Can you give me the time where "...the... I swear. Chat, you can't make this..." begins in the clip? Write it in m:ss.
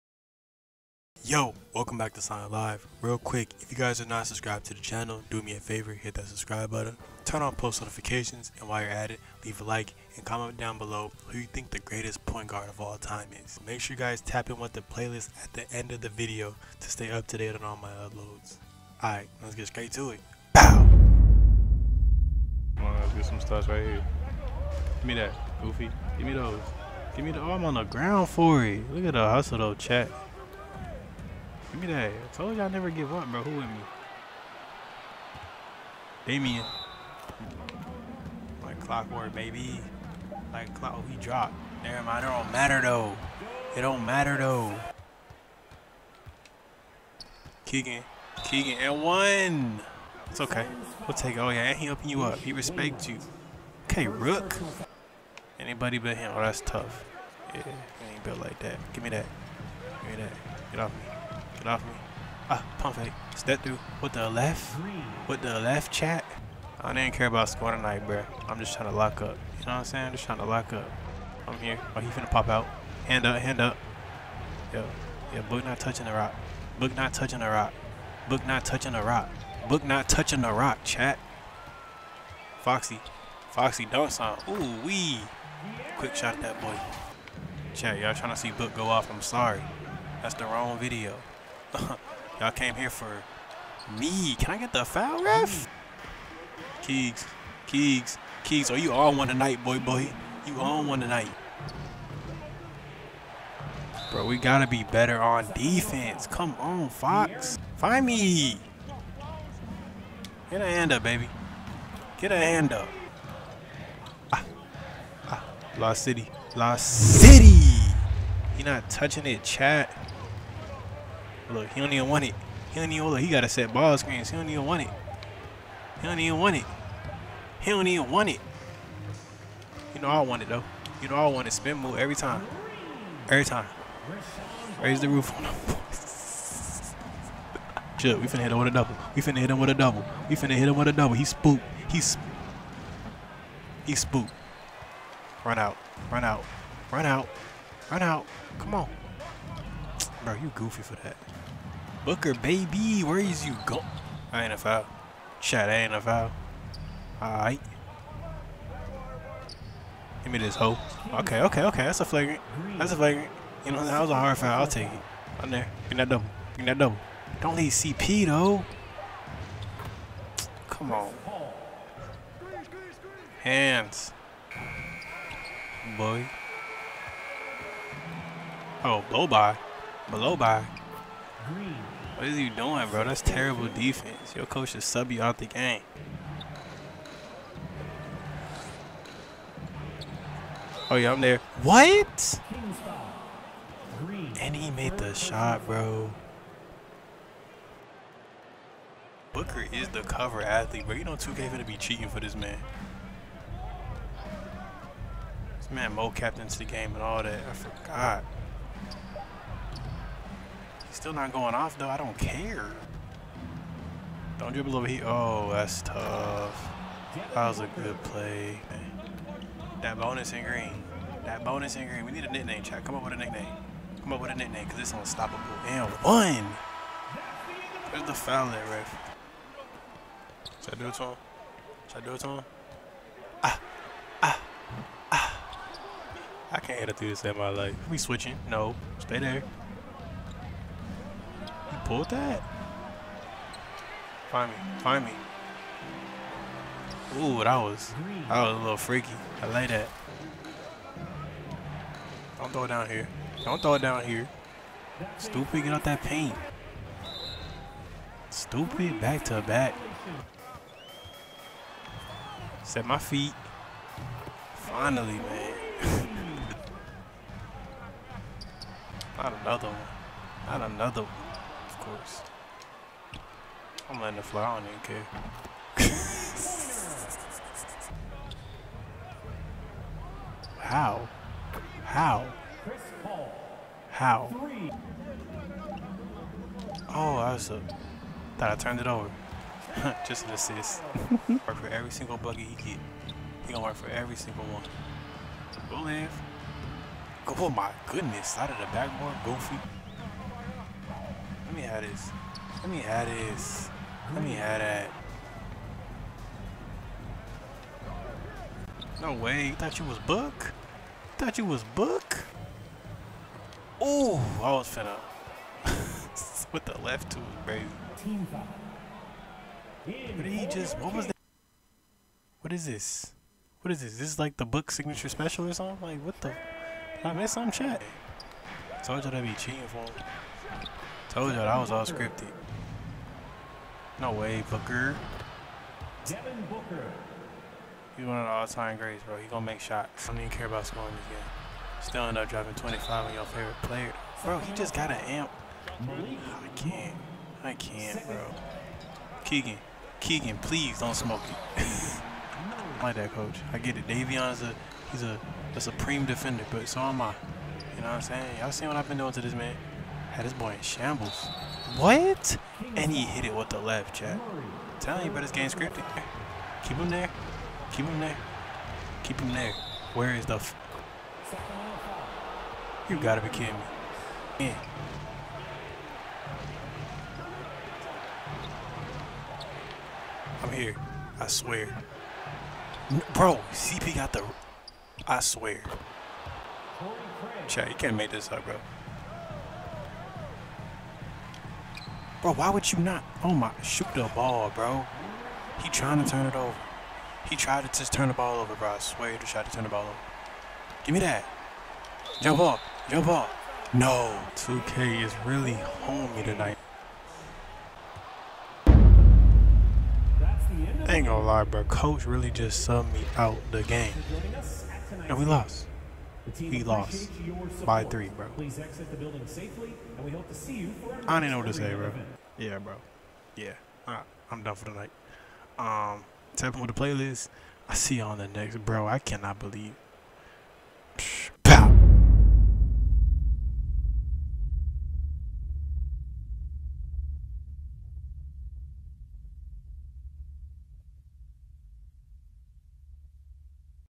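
6:24.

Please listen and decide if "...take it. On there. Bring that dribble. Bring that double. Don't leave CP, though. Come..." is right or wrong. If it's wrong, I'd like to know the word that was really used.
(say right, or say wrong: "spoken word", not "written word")
wrong: "double", not "dribble".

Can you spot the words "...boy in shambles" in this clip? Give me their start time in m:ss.
6:00.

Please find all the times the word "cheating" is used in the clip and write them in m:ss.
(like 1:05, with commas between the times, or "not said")
3:21, 5:29.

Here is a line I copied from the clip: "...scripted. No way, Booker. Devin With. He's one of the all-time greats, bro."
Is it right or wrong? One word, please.
wrong.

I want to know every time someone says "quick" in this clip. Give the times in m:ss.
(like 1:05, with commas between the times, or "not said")
0:03, 1:25.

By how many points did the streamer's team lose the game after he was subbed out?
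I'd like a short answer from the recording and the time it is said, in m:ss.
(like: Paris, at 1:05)
3, at 6:57.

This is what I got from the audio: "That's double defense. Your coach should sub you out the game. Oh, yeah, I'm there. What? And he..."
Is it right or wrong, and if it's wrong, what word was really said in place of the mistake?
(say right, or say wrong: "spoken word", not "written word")
wrong: "terrible", not "double".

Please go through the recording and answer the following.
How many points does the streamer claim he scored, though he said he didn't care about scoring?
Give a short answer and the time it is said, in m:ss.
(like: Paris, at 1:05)
25, at 5:42.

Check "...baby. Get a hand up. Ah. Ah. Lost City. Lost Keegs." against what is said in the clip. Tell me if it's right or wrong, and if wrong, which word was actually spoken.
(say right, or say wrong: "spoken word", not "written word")
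wrong: "City", not "Keegs".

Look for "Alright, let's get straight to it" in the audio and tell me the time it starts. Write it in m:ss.
0:19.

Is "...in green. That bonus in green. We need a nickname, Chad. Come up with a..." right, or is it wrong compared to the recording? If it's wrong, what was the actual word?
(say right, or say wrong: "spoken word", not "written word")
right.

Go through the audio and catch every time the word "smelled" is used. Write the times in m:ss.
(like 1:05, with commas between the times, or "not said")
not said.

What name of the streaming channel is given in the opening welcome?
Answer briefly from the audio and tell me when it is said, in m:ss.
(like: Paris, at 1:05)
Syon Live, at 0:02.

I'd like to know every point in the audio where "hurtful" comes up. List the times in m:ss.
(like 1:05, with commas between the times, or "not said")
not said.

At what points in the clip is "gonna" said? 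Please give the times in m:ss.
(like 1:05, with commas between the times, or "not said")
3:21, 4:53, 5:39, 6:51.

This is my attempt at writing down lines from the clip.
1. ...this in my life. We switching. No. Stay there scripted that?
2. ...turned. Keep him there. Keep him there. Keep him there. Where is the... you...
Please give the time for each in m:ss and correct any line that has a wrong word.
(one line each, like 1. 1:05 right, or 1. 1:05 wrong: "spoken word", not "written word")
1. 3:57 wrong: "pulled", not "scripted"
2. 6:05 wrong: "scripted", not "turned".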